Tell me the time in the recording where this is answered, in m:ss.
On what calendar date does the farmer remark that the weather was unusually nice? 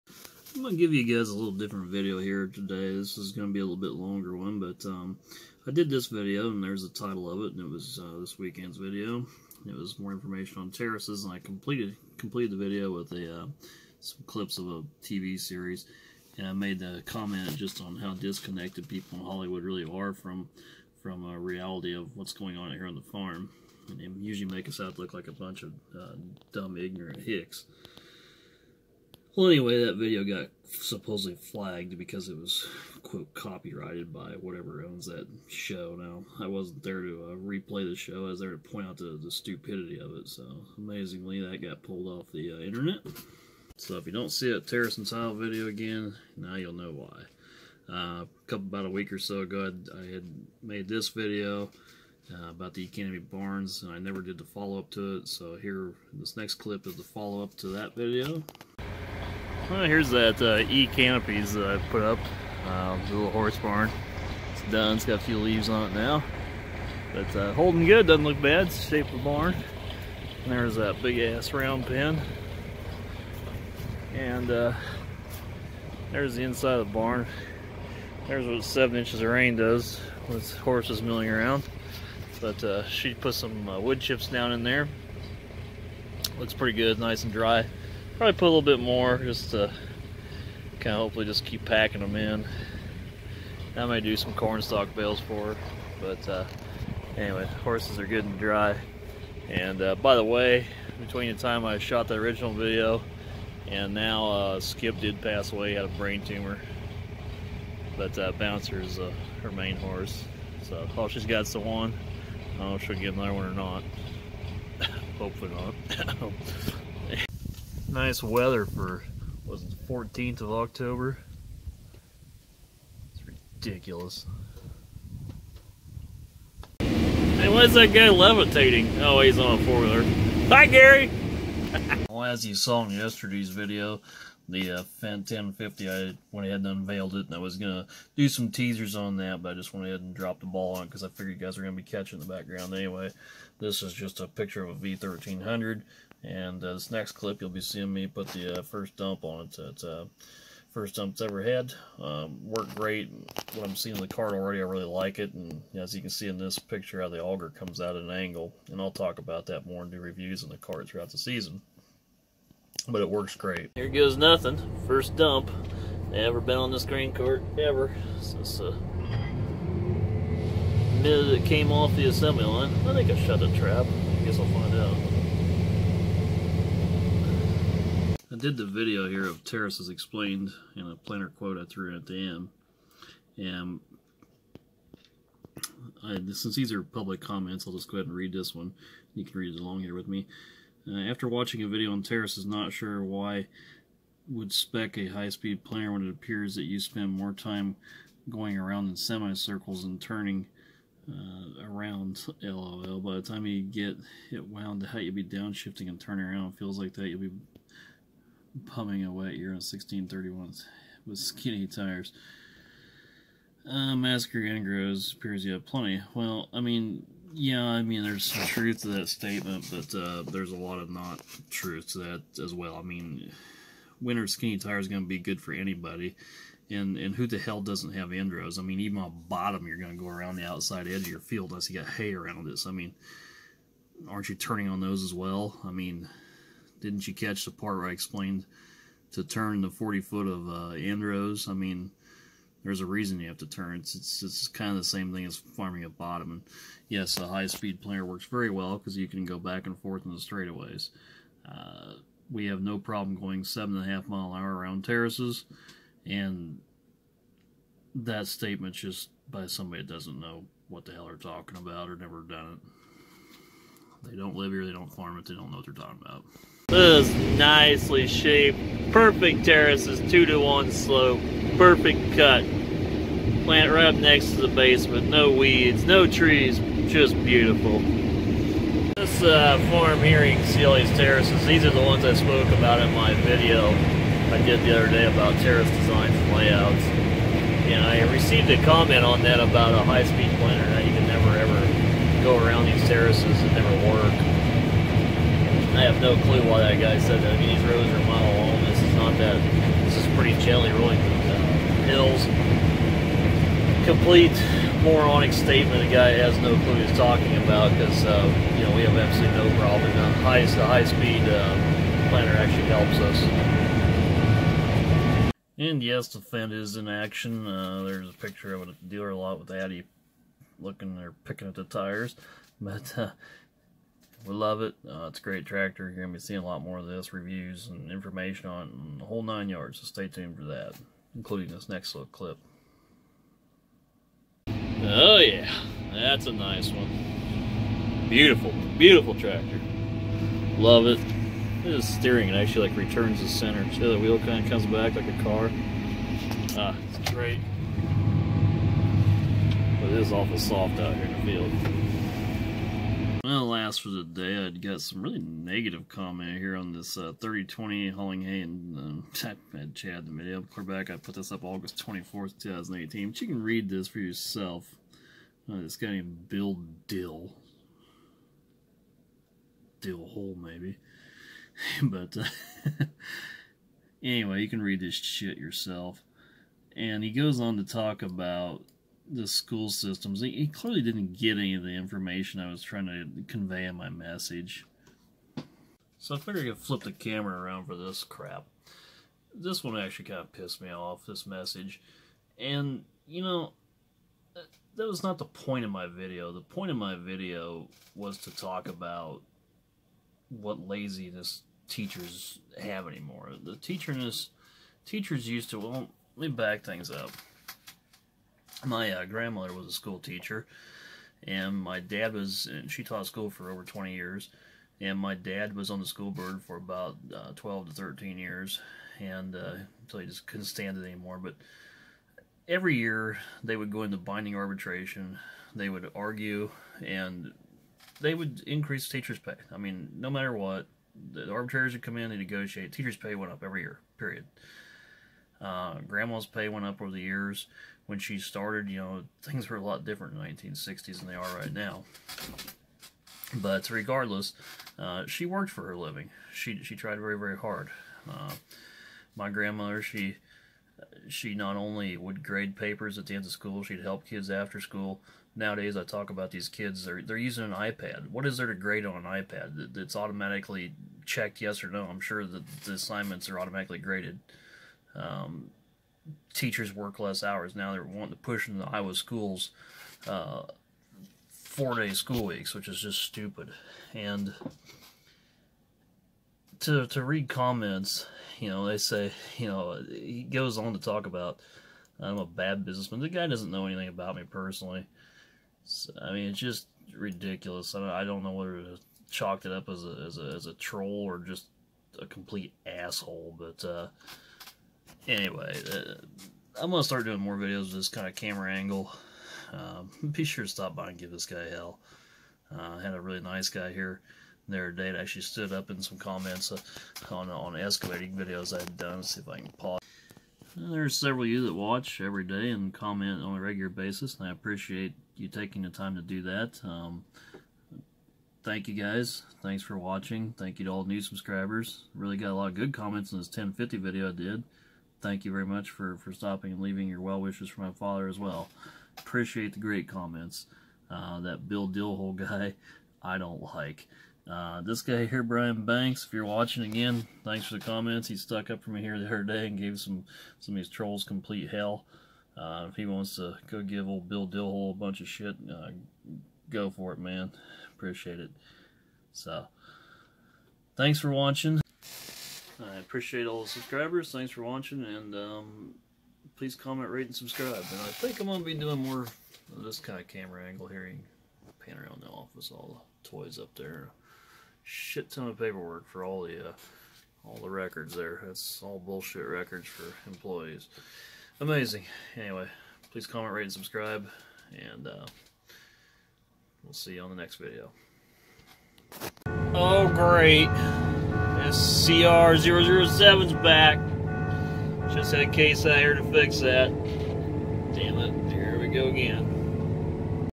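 1:59.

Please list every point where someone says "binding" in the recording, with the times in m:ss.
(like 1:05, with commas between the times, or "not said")
7:03.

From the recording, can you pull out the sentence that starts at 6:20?
He clearly didn't get any of the information I was trying to convey in my message.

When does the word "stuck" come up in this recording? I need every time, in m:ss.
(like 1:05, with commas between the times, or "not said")
8:58.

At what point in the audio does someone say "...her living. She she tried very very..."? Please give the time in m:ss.
7:25.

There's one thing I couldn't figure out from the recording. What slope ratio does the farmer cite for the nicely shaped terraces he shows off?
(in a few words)
2 to 1.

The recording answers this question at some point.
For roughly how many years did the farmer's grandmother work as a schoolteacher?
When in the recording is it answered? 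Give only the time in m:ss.
6:53.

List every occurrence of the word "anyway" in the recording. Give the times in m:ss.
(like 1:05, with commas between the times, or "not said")
0:29, 1:37, 2:22, 6:14, 8:15, 9:32.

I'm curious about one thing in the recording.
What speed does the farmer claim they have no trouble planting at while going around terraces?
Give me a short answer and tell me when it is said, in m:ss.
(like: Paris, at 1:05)
7.5 mph, at 4:13.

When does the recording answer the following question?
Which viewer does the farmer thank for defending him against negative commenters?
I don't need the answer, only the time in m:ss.
8:55.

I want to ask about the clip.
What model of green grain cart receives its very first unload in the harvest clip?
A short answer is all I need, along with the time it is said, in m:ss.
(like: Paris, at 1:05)
V1300, at 2:24.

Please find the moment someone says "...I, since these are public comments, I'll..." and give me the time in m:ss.
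3:06.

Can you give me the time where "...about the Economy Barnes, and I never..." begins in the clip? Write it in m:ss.
0:52.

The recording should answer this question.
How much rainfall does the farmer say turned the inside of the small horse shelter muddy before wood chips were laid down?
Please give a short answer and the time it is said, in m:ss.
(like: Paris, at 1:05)
7 inches, at 1:18.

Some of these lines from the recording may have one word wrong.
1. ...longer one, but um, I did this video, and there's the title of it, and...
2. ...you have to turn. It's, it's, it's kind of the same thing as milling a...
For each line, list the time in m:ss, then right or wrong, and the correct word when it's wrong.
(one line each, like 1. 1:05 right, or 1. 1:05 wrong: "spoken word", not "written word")
1. 0:03 right
2. 4:03 wrong: "farming", not "milling".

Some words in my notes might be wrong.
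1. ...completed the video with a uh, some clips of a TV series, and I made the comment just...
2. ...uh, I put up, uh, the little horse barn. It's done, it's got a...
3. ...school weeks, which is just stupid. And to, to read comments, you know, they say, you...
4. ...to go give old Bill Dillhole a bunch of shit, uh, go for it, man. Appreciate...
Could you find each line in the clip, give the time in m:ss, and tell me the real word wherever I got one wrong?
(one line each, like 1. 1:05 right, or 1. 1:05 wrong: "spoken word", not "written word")
1. 0:12 right
2. 1:01 right
3. 7:51 right
4. 9:03 right.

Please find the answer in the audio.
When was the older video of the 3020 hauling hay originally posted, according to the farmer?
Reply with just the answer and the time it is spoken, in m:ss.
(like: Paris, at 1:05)
August 24, 2018, at 6:01.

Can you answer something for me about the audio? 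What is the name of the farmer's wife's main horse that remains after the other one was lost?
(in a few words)
Bouncer.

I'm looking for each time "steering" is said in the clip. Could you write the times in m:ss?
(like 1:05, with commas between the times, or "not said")
5:41.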